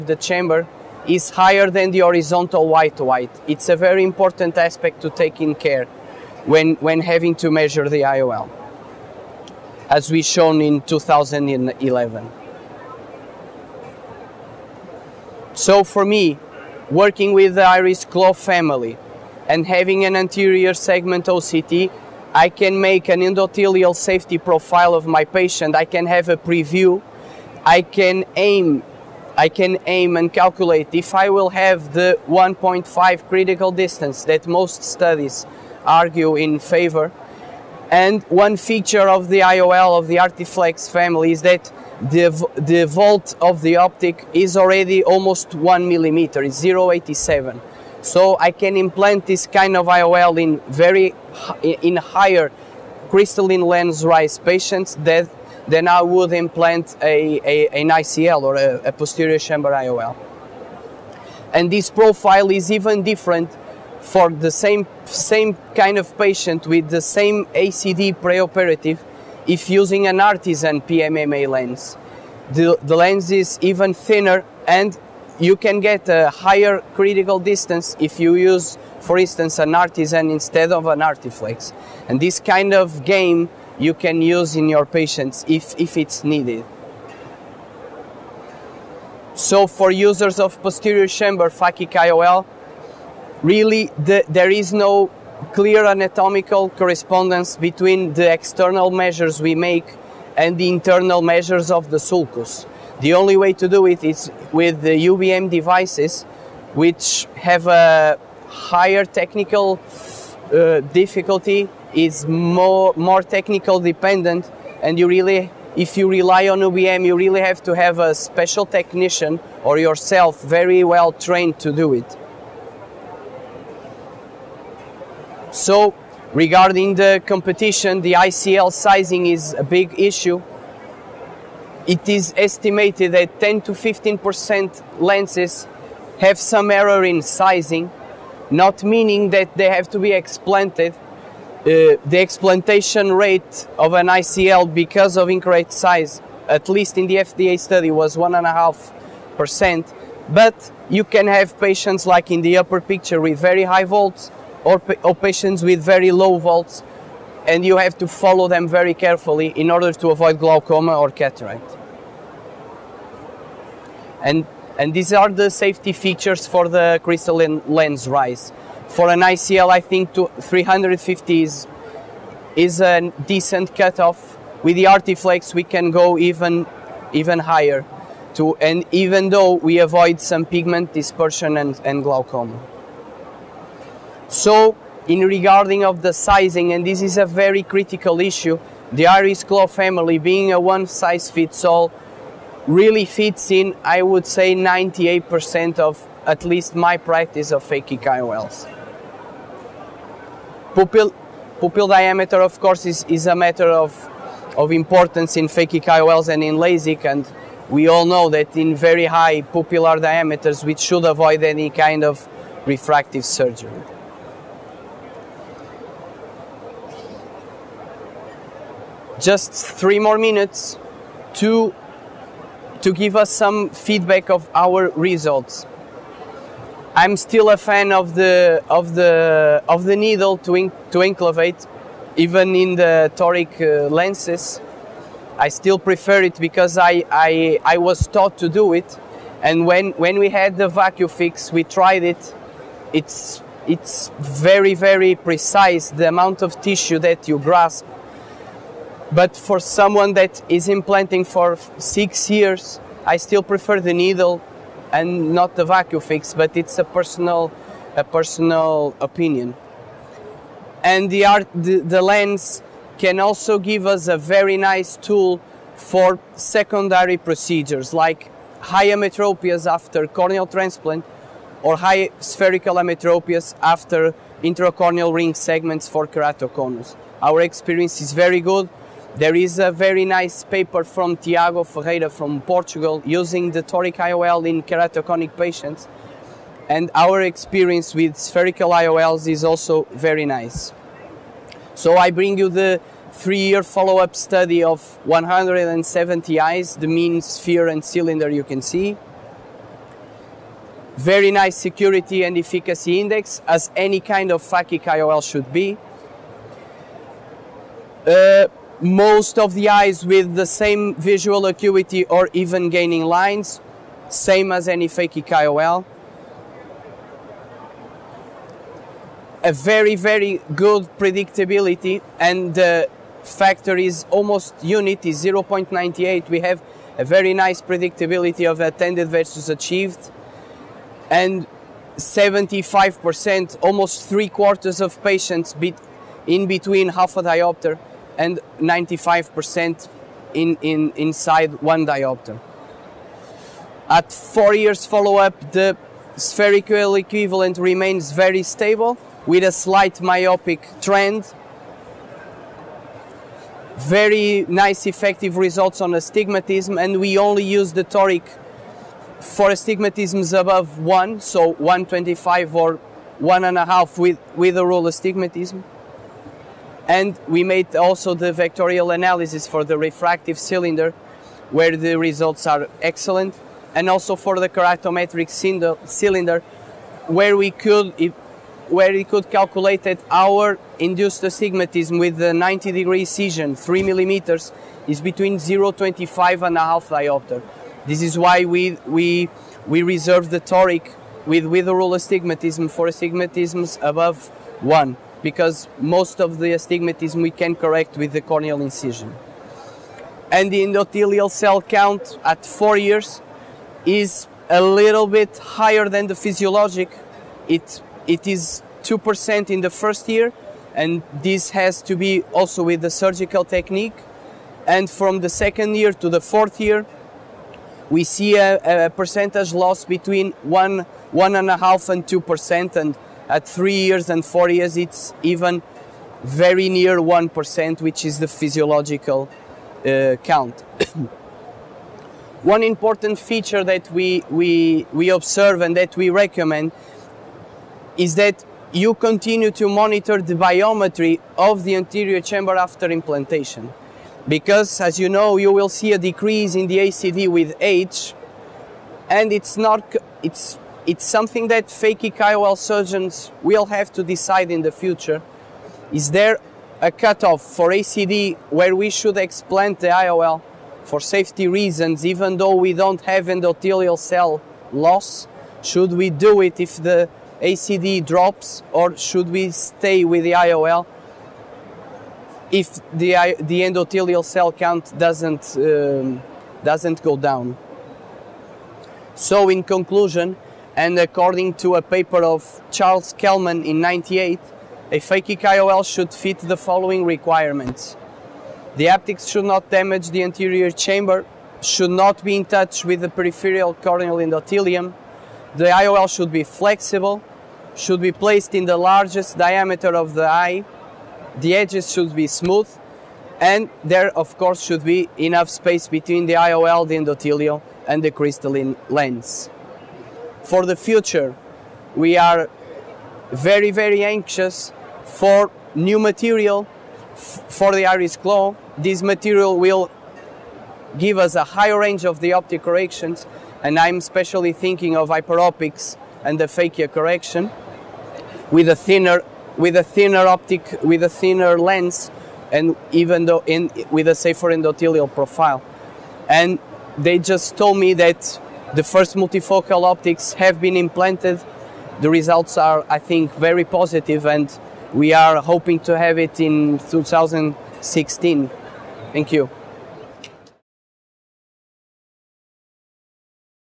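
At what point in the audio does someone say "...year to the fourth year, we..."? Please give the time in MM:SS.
06:55.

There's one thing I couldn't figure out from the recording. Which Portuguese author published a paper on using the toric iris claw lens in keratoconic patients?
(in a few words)
Tiago Ferreira.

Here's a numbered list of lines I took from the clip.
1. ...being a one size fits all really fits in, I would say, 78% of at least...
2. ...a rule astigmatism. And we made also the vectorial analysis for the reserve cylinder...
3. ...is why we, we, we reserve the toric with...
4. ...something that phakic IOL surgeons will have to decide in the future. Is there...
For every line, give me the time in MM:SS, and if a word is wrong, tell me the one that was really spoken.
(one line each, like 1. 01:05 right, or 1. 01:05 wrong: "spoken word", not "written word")
1. 03:10 wrong: "98", not "78"
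2. 06:04 wrong: "refractive", not "reserve"
3. 06:28 right
4. 07:31 right.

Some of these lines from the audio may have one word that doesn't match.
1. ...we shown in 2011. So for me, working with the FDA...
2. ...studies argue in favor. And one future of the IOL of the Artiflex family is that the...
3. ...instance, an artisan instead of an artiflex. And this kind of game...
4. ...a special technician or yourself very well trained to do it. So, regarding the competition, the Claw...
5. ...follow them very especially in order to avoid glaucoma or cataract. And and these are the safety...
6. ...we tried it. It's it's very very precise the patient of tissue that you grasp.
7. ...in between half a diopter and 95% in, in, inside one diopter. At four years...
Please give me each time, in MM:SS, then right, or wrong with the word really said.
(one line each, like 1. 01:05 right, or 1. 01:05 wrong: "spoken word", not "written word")
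1. 00:10 wrong: "Iris", not "FDA"
2. 00:34 wrong: "feature", not "future"
3. 01:19 right
4. 01:57 wrong: "ICL", not "Claw"
5. 02:38 wrong: "carefully", not "especially"
6. 04:01 wrong: "amount", not "patient"
7. 05:36 right.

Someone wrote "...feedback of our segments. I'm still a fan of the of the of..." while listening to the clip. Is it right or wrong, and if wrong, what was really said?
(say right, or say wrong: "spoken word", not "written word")
wrong: "results", not "segments".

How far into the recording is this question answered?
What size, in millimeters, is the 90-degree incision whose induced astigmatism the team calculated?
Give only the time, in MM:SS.
06:23.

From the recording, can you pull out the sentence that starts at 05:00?
Very nice security and efficacy index, as any kind of phakic IOL should be.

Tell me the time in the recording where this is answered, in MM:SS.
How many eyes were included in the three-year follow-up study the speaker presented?
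04:55.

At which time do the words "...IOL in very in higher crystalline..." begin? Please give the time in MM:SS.
00:49.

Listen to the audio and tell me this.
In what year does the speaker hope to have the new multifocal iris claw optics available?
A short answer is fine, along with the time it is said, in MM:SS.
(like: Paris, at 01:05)
2016, at 09:06.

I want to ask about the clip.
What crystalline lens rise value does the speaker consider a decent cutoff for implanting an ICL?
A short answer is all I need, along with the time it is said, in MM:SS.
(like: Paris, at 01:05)
350, at 02:50.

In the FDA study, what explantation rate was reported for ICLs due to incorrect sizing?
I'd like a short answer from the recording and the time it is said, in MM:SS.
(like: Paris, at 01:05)
1.5%, at 02:28.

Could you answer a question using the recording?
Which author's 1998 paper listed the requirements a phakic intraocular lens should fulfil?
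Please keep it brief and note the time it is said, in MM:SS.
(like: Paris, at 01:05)
Charles Kelman, at 08:02.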